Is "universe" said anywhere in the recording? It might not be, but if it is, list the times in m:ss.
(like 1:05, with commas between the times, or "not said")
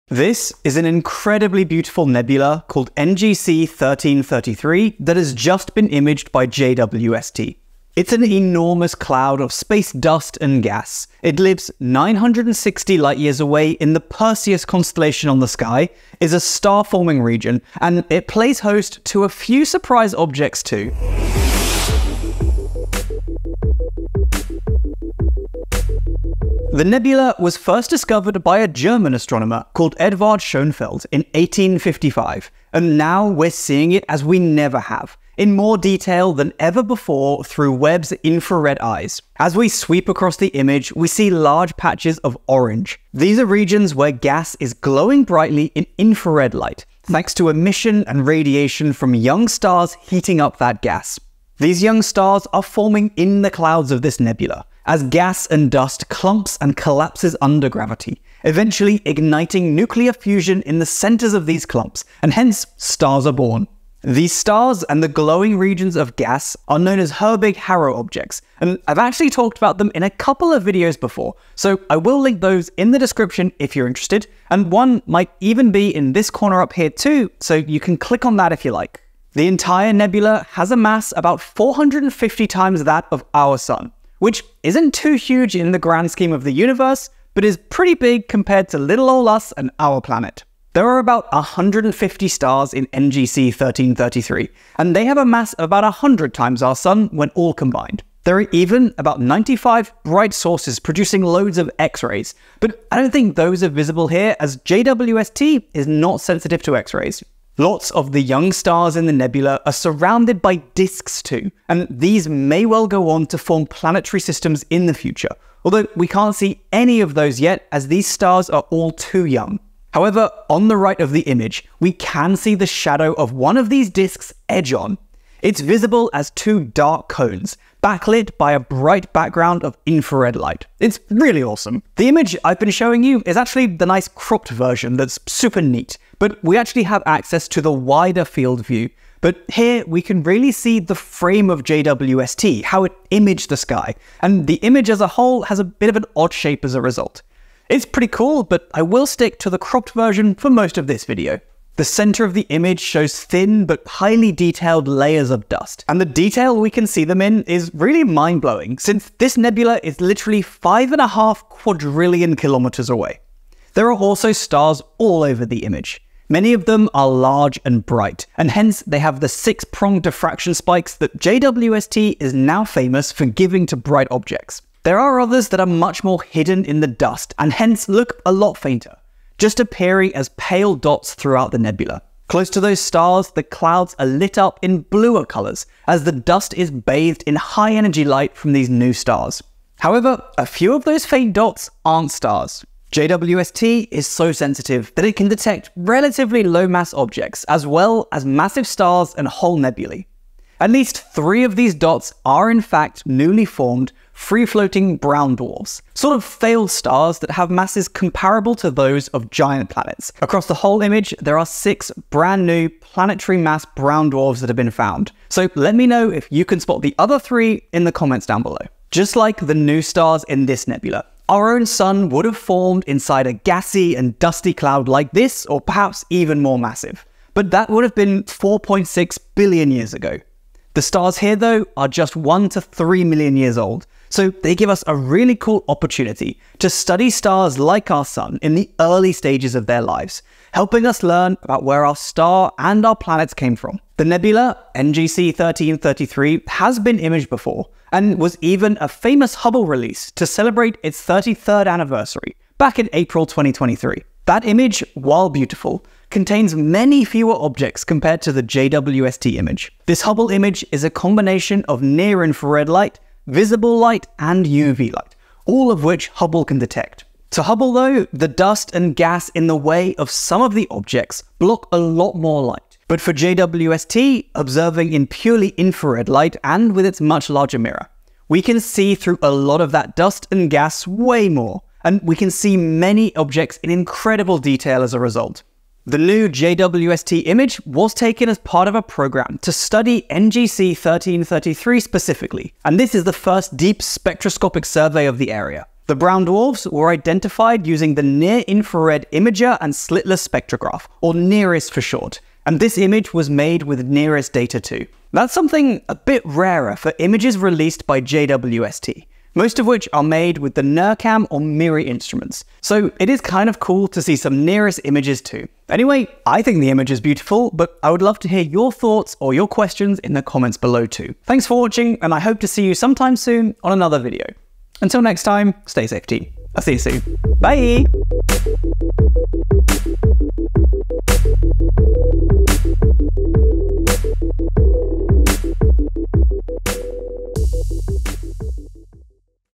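1:26.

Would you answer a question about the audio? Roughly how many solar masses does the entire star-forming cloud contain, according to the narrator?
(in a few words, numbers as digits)
450.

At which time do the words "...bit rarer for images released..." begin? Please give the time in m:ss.
5:05.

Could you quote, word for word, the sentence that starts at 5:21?
Thanks for watching, and I hope to see you sometime soon on another video.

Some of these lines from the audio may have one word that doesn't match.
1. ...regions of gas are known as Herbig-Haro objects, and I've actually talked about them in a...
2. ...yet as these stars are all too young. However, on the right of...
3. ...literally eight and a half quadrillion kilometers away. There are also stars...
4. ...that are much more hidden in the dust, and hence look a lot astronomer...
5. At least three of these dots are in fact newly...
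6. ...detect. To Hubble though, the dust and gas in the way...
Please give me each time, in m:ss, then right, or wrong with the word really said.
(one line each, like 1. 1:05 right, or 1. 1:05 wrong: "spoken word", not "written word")
1. 1:05 right
2. 1:57 right
3. 2:40 wrong: "five", not "eight"
4. 2:55 wrong: "fainter", not "astronomer"
5. 3:20 right
6. 4:26 right.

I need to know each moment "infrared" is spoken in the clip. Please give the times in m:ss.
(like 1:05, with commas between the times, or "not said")
0:38, 0:45, 2:09, 4:22, 4:35, 4:58.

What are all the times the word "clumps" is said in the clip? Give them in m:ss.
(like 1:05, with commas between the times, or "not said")
0:56, 1:01.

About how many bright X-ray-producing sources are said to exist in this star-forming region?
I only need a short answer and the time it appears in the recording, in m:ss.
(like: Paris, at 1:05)
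95, at 1:39.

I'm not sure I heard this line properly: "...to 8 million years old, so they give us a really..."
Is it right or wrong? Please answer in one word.
wrong.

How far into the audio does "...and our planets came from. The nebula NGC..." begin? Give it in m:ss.
4:02.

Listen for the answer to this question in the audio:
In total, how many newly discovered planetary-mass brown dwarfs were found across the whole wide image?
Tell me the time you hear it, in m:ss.
3:31.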